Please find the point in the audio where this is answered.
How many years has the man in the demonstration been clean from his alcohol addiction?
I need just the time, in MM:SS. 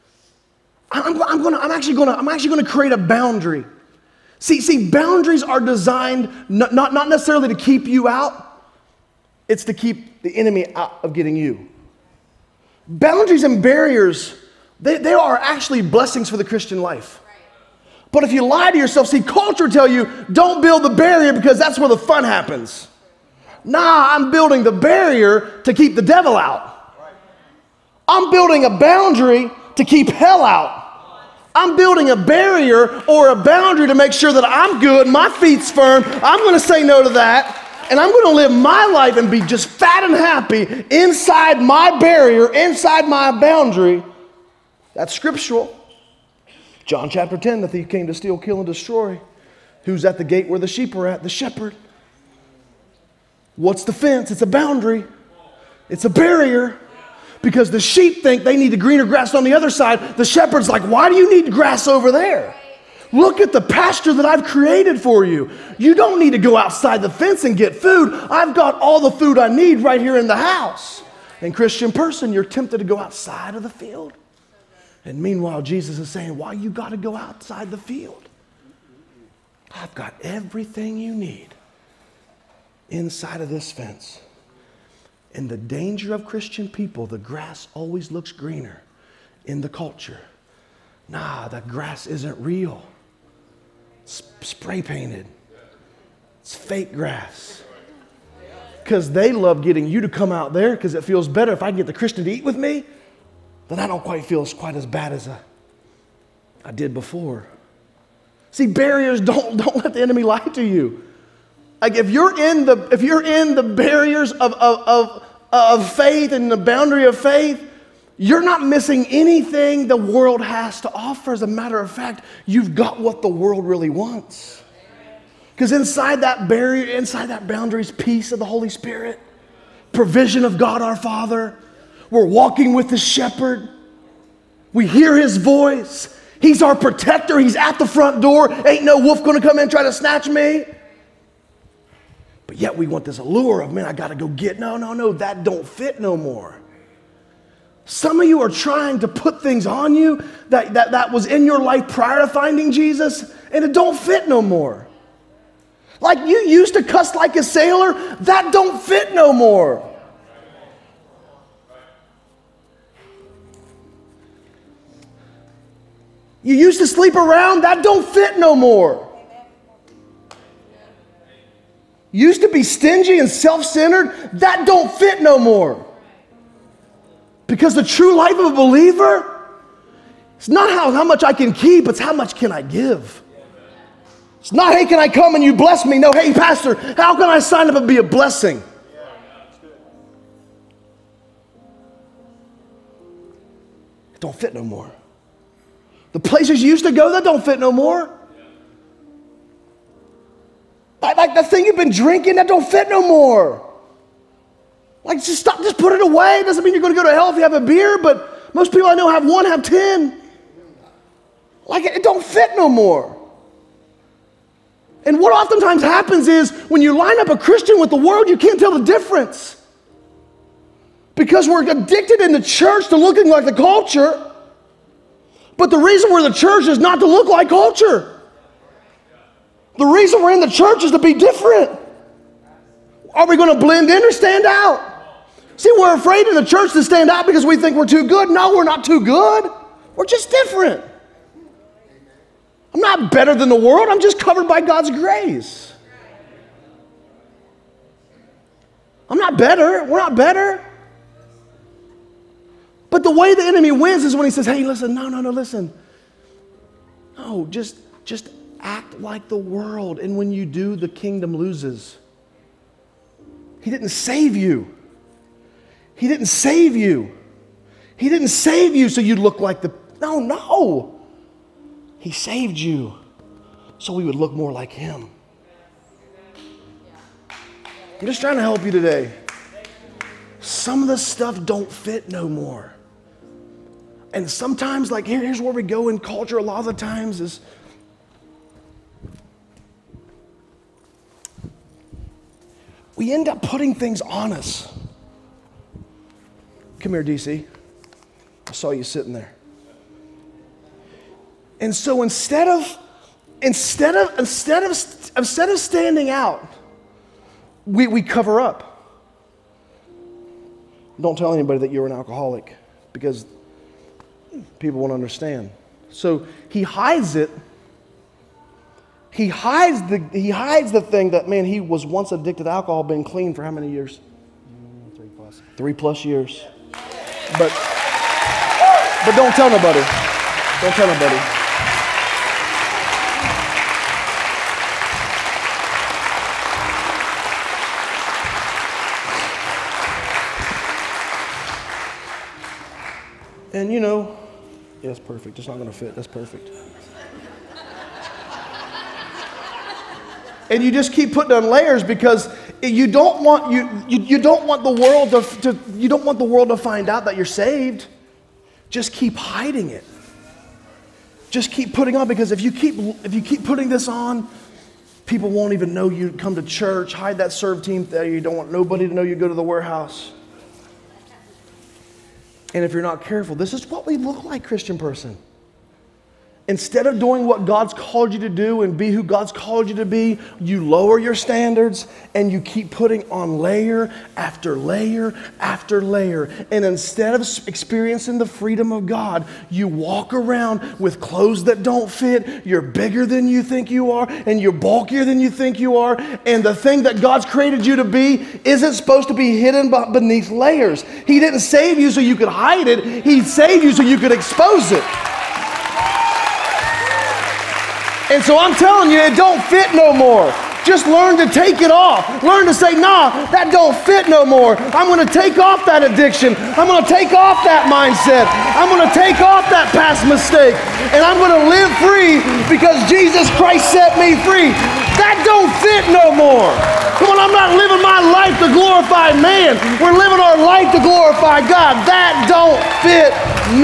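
05:25.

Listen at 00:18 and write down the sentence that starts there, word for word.
But if you lie to yourself, see, culture tell you, don't build the barrier because that's where the fun happens.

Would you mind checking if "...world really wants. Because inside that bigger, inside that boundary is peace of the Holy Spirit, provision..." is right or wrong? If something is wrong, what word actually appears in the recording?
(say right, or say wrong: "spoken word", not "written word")
wrong: "barrier", not "bigger".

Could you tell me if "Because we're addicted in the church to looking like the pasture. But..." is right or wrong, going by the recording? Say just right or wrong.
wrong.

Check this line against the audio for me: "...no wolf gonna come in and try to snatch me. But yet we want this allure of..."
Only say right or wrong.
right.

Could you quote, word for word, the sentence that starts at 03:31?
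Like, it, it don't fit no more.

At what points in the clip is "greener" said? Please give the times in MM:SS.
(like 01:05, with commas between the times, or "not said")
00:58, 01:28.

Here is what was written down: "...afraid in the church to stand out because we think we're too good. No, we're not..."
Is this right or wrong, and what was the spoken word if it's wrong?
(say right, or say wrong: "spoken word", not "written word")
right.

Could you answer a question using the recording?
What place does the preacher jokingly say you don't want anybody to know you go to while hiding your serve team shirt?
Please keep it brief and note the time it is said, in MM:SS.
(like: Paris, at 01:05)
The warehouse, at 06:09.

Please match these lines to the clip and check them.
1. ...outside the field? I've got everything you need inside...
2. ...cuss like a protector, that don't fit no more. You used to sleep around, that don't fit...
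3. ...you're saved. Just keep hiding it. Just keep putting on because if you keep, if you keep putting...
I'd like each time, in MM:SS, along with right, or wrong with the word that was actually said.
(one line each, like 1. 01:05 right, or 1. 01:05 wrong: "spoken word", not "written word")
1. 01:17 right
2. 02:36 wrong: "sailor", not "protector"
3. 05:57 right.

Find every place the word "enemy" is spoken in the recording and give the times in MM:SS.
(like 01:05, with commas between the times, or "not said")
00:10, 01:50, 04:13.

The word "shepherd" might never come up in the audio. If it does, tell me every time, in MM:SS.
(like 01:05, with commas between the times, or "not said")
00:51, 01:00, 02:12.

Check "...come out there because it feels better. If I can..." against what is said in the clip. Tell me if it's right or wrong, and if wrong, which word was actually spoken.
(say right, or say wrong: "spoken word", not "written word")
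right.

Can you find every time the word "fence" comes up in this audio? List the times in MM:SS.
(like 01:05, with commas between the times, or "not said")
00:53, 01:07, 01:23.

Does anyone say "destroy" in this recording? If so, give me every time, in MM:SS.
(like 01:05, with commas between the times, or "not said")
00:48.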